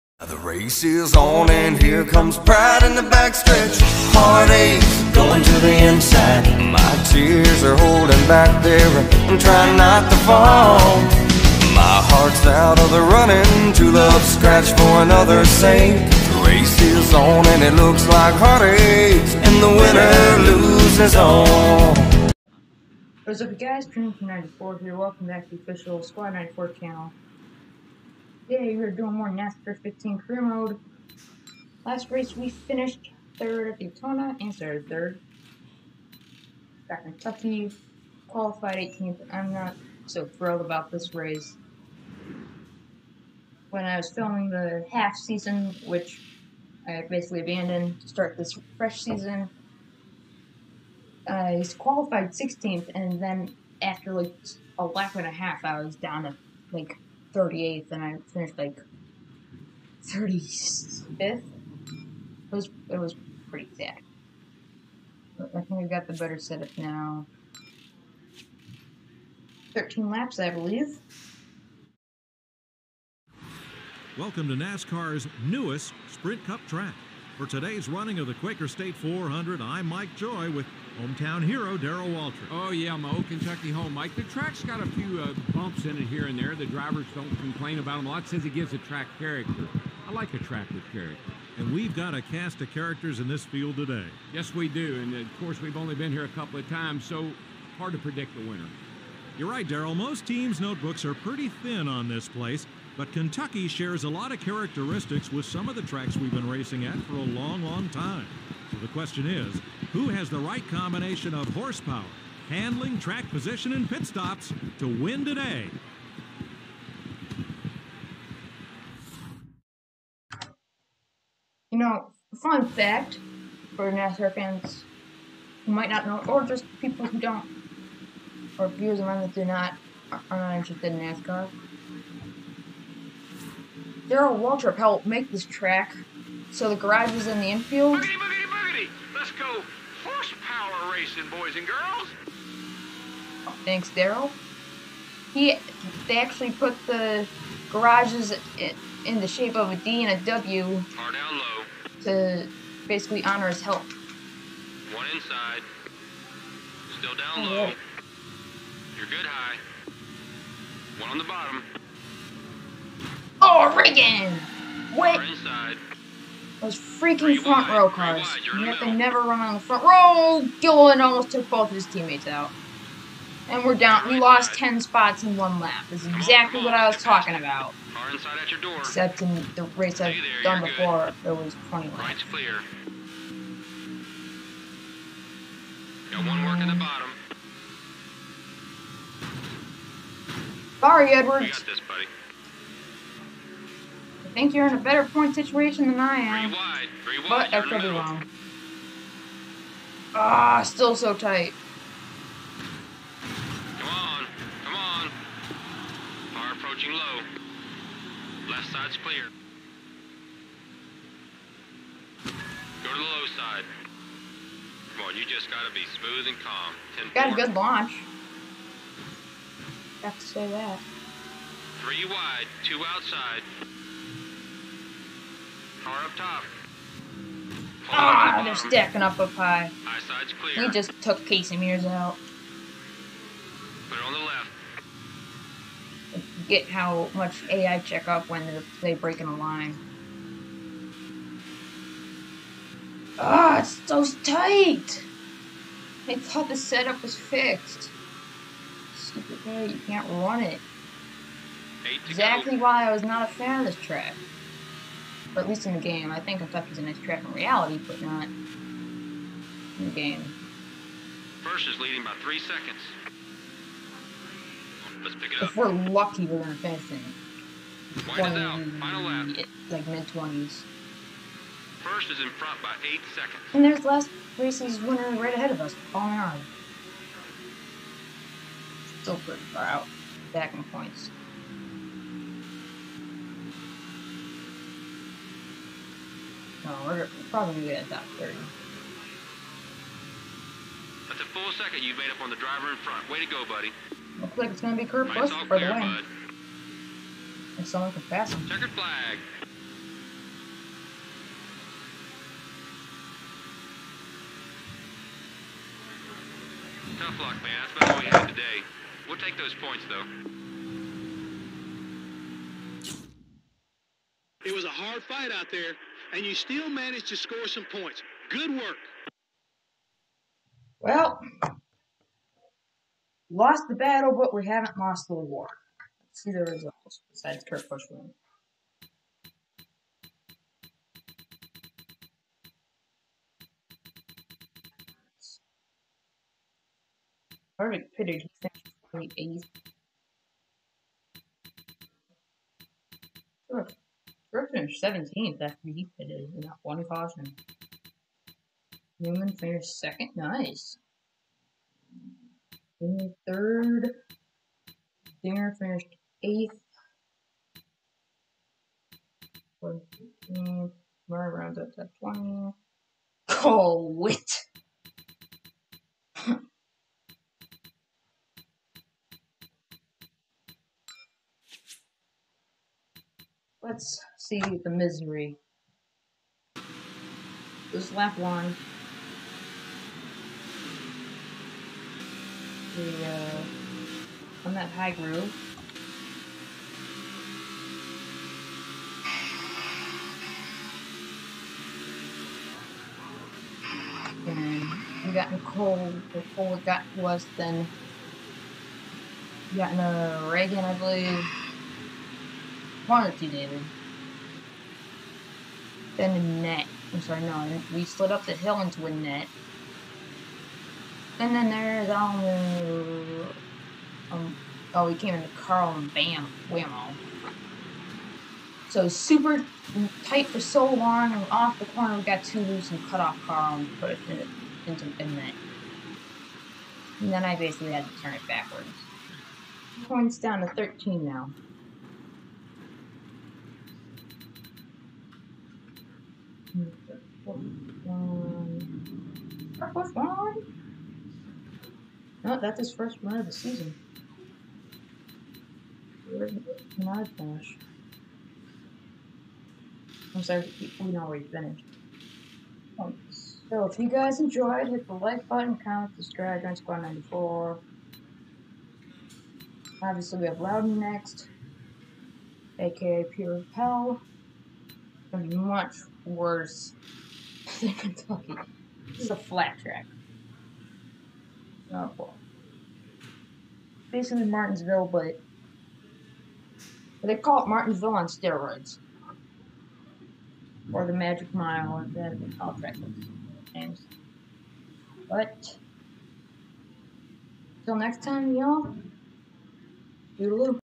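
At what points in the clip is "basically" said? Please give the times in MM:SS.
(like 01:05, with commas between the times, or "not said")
00:47, 02:32, 07:07, 07:53.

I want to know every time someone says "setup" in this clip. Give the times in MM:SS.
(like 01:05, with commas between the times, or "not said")
01:06, 04:06.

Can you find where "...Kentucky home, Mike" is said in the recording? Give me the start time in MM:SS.
01:23.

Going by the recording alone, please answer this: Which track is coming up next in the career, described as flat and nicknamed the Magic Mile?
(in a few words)
Loudon.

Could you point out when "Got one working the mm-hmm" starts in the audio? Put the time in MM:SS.
03:06.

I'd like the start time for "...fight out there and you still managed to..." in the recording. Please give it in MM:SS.
05:15.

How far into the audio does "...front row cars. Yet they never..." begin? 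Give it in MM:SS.
02:47.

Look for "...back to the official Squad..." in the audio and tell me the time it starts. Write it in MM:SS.
00:25.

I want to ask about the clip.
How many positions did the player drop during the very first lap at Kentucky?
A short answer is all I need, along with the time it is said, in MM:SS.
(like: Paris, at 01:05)
10, at 02:54.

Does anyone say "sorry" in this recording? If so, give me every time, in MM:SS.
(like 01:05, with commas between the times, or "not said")
03:10, 06:47, 07:30.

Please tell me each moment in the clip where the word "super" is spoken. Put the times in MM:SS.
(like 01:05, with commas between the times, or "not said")
06:58.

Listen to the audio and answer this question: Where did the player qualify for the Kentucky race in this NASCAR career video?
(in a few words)
18th.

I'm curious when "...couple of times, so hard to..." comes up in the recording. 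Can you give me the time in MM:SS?
01:36.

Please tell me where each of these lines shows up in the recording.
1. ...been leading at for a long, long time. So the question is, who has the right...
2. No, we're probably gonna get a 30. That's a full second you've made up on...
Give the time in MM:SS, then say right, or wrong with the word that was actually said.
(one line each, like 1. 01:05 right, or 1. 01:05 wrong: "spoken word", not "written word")
1. 01:46 wrong: "racing", not "leading"
2. 04:46 right.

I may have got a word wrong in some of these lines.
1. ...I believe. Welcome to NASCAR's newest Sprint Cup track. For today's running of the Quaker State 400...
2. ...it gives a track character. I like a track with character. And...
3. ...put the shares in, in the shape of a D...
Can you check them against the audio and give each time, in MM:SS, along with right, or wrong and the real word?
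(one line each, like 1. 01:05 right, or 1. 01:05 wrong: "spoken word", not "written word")
1. 01:10 right
2. 01:28 right
3. 02:26 wrong: "garages", not "shares".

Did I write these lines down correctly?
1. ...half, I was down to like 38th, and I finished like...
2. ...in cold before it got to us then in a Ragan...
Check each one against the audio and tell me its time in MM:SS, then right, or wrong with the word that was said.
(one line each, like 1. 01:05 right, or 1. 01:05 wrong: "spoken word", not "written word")
1. 00:55 right
2. 06:35 right.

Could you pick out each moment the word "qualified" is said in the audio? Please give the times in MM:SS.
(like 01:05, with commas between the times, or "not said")
00:38, 00:51.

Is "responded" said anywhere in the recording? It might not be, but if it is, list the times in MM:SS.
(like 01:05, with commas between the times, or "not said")
not said.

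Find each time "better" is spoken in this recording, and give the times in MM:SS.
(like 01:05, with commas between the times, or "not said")
01:06, 03:14.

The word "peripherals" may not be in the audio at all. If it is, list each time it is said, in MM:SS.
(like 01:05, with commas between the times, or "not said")
not said.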